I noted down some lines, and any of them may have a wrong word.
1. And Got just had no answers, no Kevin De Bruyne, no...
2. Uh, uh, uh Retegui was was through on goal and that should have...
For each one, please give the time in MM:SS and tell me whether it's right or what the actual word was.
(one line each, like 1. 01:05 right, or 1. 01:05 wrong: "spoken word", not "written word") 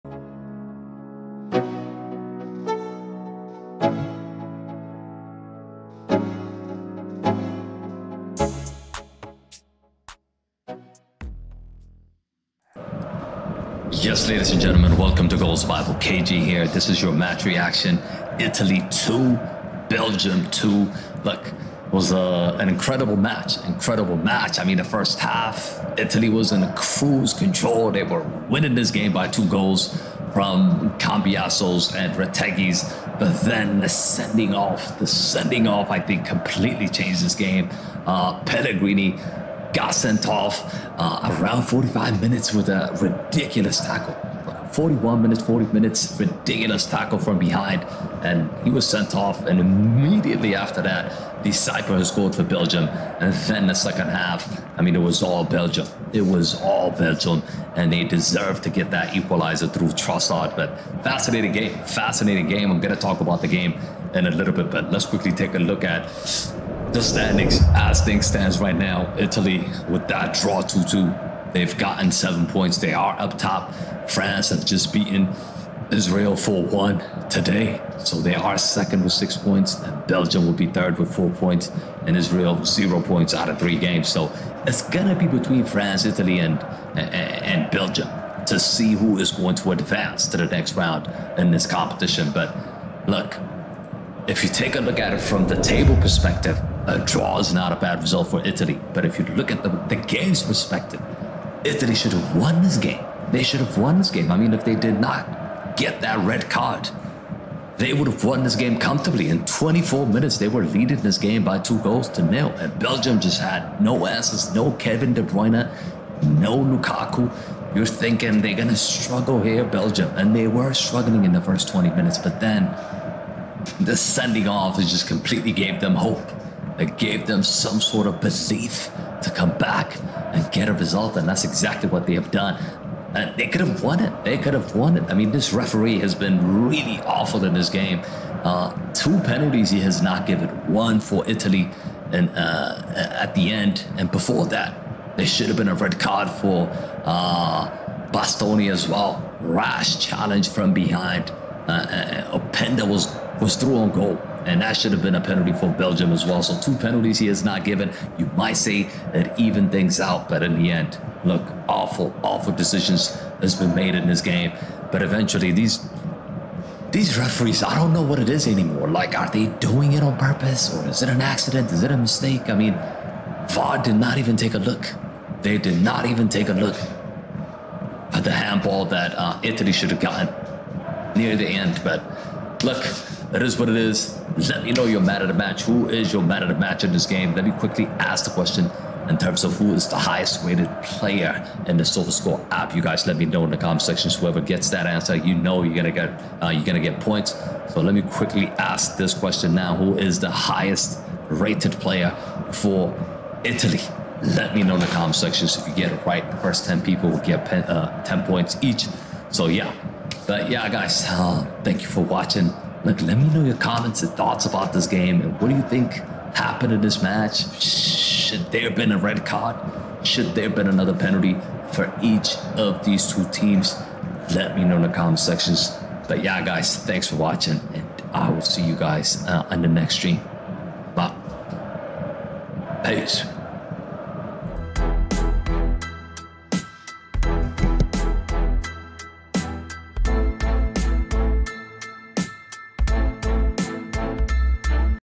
1. 01:52 wrong: "Belgium", not "Got"
2. 02:31 wrong: "Openda", not "Retegui".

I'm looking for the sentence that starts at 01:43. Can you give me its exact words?
They should have won this game.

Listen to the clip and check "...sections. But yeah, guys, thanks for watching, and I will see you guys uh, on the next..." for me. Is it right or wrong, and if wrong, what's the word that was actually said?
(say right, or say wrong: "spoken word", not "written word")
right.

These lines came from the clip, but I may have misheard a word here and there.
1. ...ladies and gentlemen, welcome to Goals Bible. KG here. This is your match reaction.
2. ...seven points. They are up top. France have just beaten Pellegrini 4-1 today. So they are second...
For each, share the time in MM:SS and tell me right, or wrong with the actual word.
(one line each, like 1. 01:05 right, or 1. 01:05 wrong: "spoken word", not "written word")
1. 00:14 right
2. 01:12 wrong: "Israel", not "Pellegrini".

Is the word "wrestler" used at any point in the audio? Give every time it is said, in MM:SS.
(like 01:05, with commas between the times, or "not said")
not said.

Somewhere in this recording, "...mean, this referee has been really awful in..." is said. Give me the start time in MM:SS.
02:15.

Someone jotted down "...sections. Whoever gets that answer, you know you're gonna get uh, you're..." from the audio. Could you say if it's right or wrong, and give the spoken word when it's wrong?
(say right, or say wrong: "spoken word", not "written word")
right.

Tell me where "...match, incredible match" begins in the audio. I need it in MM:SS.
00:23.